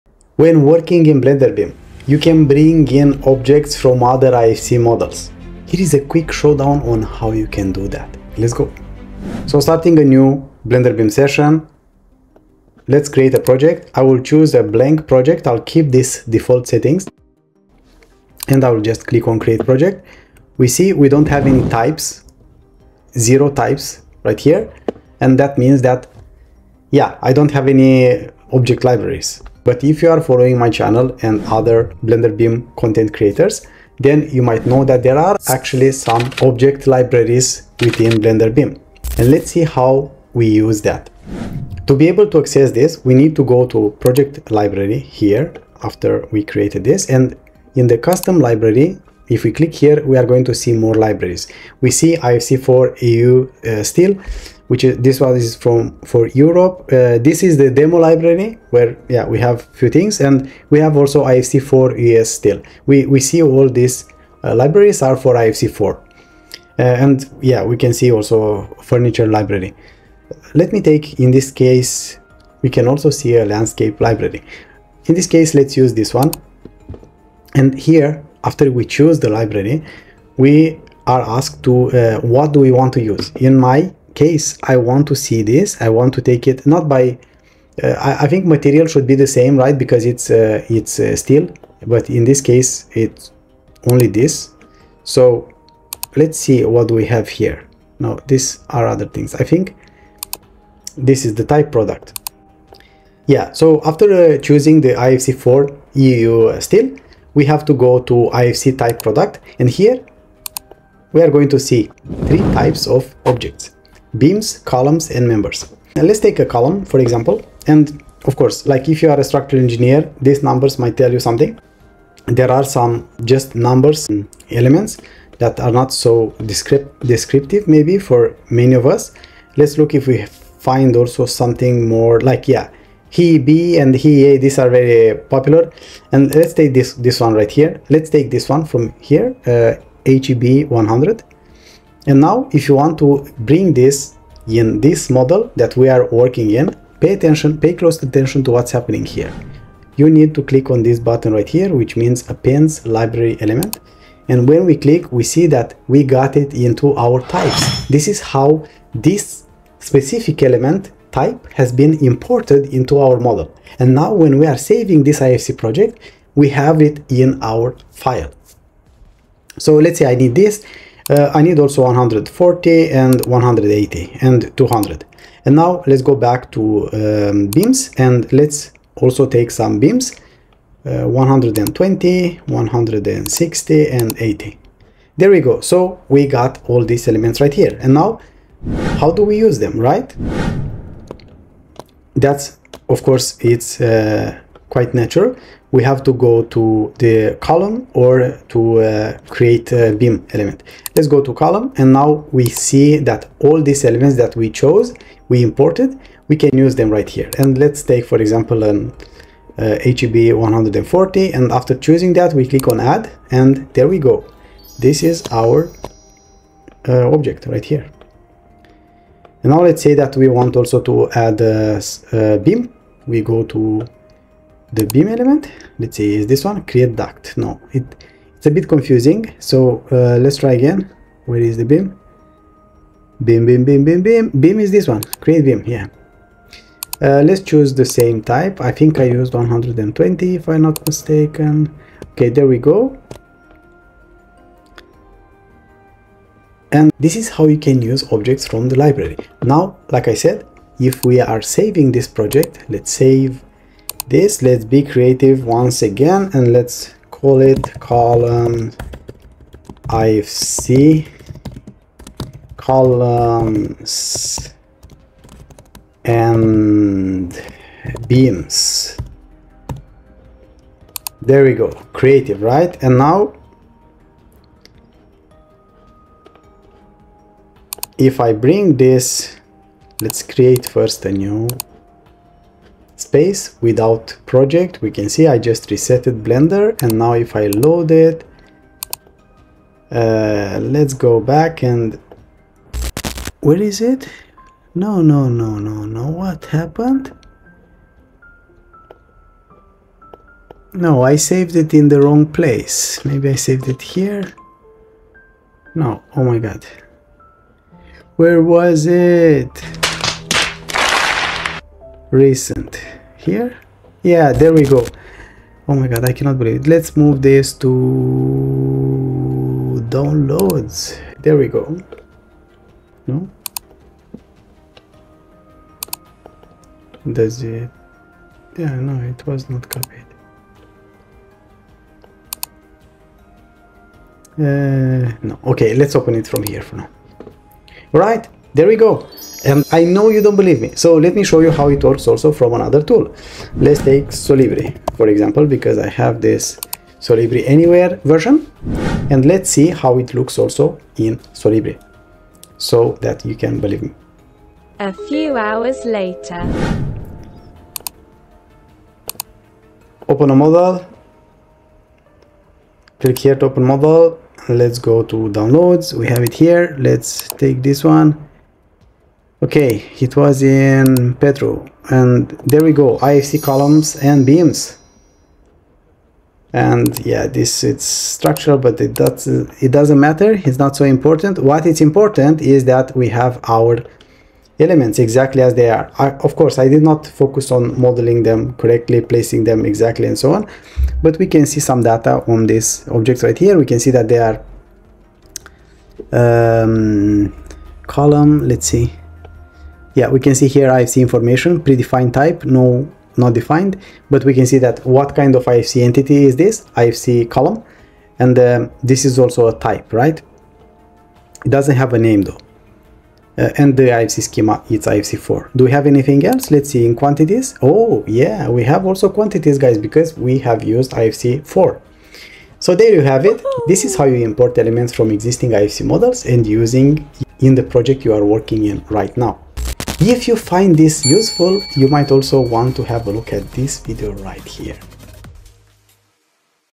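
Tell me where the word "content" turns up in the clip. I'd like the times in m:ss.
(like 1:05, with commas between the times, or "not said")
0:32.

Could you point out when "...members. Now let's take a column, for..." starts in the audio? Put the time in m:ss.
1:55.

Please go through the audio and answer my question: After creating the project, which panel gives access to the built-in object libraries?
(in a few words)
Project library.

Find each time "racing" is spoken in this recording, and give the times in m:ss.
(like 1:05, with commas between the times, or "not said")
not said.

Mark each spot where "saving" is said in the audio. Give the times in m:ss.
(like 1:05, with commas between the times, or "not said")
2:44, 4:11.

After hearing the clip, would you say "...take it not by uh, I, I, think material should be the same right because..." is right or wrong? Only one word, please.
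right.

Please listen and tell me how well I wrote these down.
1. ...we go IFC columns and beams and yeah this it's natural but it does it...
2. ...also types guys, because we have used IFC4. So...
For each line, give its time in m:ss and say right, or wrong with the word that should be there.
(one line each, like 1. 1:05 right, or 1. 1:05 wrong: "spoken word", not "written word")
1. 6:12 wrong: "structural", not "natural"
2. 6:58 wrong: "quantities", not "types".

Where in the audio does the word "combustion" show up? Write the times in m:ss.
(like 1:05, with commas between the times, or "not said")
not said.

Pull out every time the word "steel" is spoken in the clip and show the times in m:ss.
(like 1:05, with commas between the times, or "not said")
0:53, 1:02, 1:31, 1:46.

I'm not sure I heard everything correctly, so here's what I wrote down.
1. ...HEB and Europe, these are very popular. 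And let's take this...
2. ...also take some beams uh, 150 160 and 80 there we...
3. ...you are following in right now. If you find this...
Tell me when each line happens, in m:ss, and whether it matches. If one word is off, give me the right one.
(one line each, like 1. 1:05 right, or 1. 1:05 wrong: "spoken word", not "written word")
1. 2:13 wrong: "HEA", not "Europe"
2. 2:58 wrong: "120", not "150"
3. 7:08 wrong: "working", not "following".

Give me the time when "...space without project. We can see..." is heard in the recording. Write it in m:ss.
4:43.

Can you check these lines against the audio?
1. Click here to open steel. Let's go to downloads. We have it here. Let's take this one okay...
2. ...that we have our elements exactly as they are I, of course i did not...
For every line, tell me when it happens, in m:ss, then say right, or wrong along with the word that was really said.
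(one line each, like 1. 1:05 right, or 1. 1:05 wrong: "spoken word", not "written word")
1. 6:02 wrong: "model", not "steel"
2. 6:22 right.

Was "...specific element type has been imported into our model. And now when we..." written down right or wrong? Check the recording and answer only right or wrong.
right.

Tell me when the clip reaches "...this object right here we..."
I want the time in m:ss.
6:32.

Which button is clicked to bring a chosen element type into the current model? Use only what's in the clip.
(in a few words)
Appends library element.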